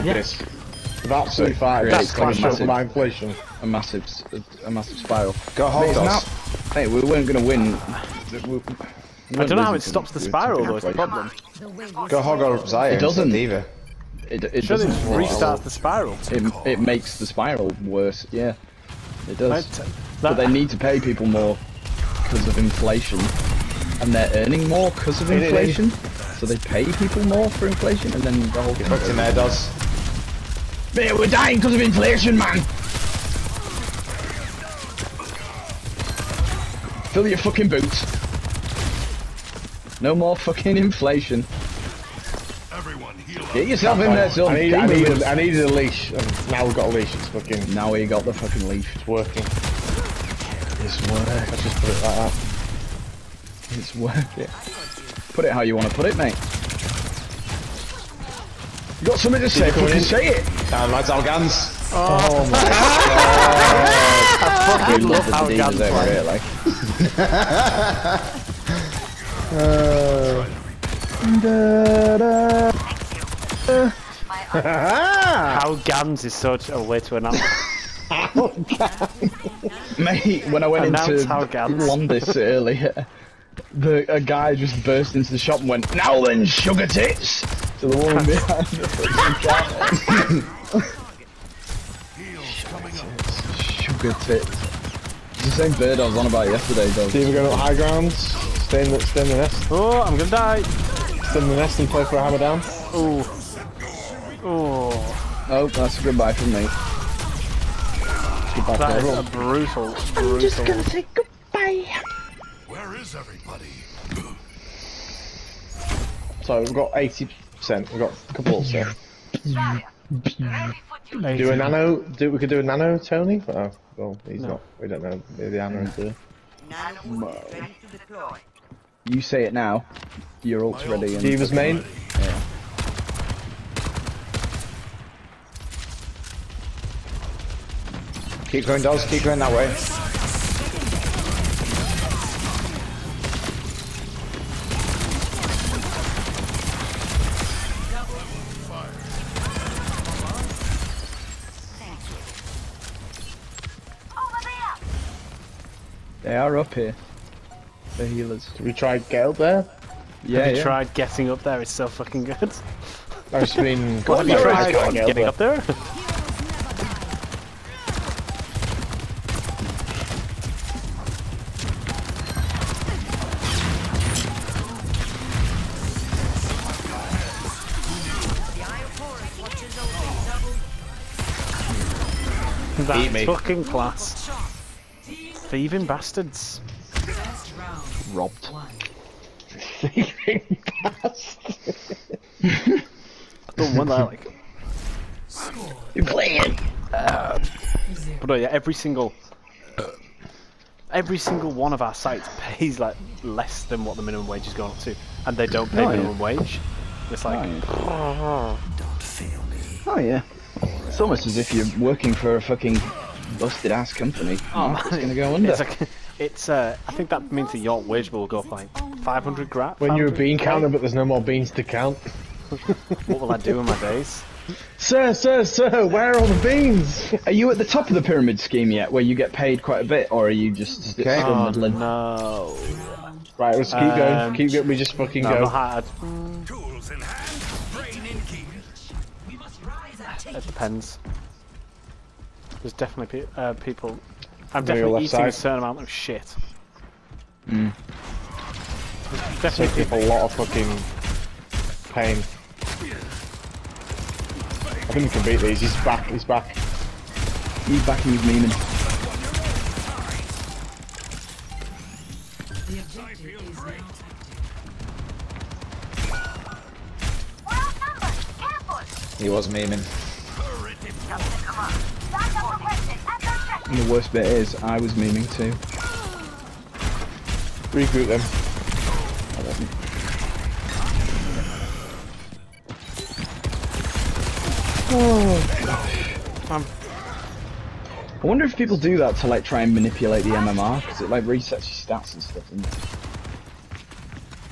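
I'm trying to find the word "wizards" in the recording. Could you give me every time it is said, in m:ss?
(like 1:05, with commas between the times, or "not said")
not said.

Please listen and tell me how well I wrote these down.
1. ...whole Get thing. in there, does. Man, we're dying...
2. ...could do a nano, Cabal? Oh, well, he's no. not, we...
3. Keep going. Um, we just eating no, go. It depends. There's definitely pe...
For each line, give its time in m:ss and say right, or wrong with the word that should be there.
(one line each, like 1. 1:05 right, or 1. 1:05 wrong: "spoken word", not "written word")
1. 0:28 right
2. 2:02 wrong: "Tony", not "Cabal"
3. 3:54 wrong: "fucking", not "eating".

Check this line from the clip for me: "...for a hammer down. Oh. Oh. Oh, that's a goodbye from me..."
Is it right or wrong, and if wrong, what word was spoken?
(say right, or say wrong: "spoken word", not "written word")
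right.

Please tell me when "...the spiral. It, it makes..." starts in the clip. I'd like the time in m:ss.
0:15.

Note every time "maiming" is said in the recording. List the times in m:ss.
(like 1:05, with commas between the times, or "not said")
4:18.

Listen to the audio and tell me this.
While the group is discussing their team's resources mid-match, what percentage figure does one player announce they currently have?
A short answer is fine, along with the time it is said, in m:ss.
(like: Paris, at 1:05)
80%, at 1:56.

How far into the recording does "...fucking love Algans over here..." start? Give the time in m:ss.
1:04.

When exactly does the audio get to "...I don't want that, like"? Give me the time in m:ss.
3:12.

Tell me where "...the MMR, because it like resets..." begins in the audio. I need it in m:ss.
4:50.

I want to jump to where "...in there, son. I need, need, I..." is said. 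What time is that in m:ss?
0:43.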